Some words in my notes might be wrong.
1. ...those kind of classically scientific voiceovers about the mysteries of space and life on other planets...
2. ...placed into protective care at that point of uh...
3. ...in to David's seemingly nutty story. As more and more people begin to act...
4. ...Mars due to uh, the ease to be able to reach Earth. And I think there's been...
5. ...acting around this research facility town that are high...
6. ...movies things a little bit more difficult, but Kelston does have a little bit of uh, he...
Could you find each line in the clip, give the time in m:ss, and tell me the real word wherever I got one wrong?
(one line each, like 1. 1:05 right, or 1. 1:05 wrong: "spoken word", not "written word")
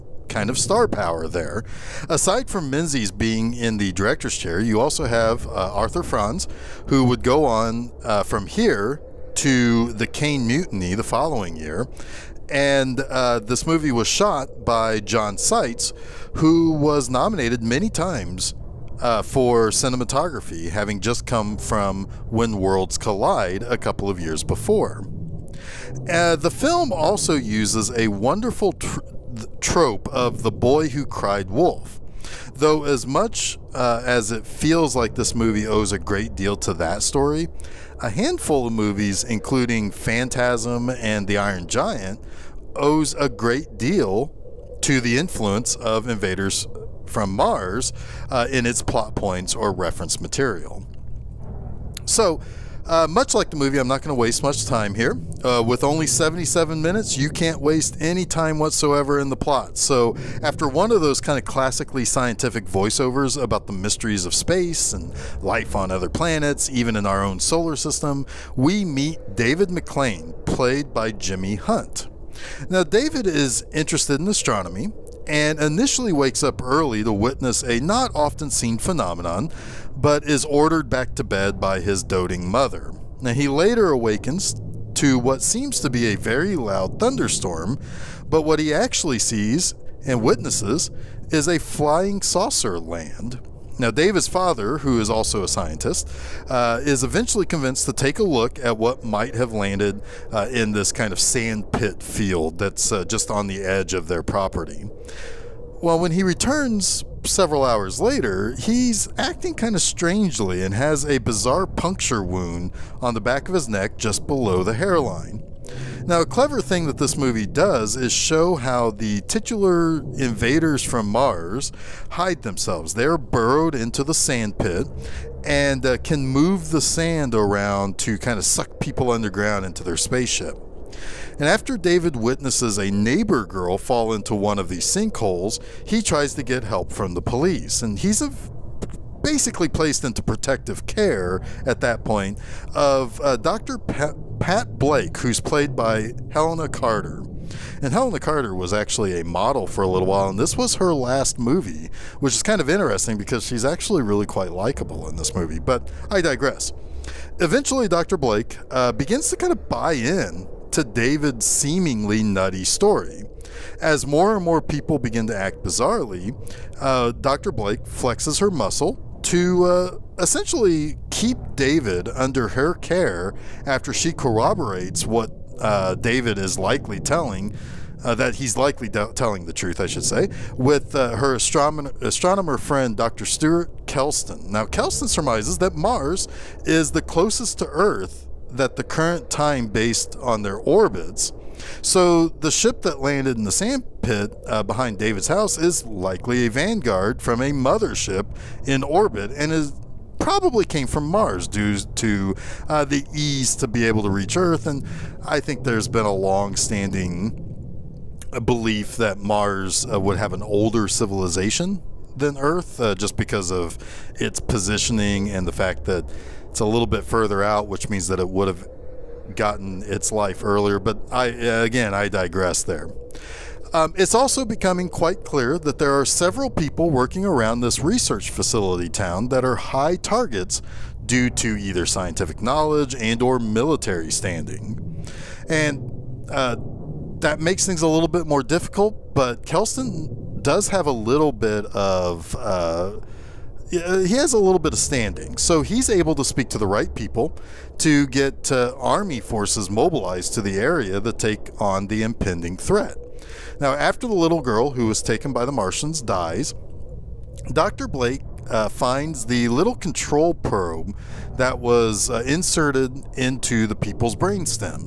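1. 1:00 right
2. 2:19 right
3. 2:39 right
4. 3:21 right
5. 3:46 wrong: "working", not "acting"
6. 3:57 wrong: "makes", not "movies".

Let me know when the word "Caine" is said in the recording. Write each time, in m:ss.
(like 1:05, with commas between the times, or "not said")
0:10.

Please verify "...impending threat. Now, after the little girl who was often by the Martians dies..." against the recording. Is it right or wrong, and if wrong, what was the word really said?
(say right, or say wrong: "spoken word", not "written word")
wrong: "taken", not "often".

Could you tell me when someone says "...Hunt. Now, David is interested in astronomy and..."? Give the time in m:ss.
1:11.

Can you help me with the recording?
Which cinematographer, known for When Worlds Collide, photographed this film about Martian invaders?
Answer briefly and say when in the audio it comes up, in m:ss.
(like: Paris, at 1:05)
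John Seitz, at 0:14.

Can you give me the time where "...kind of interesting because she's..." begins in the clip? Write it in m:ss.
2:32.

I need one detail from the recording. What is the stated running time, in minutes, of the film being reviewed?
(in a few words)
77.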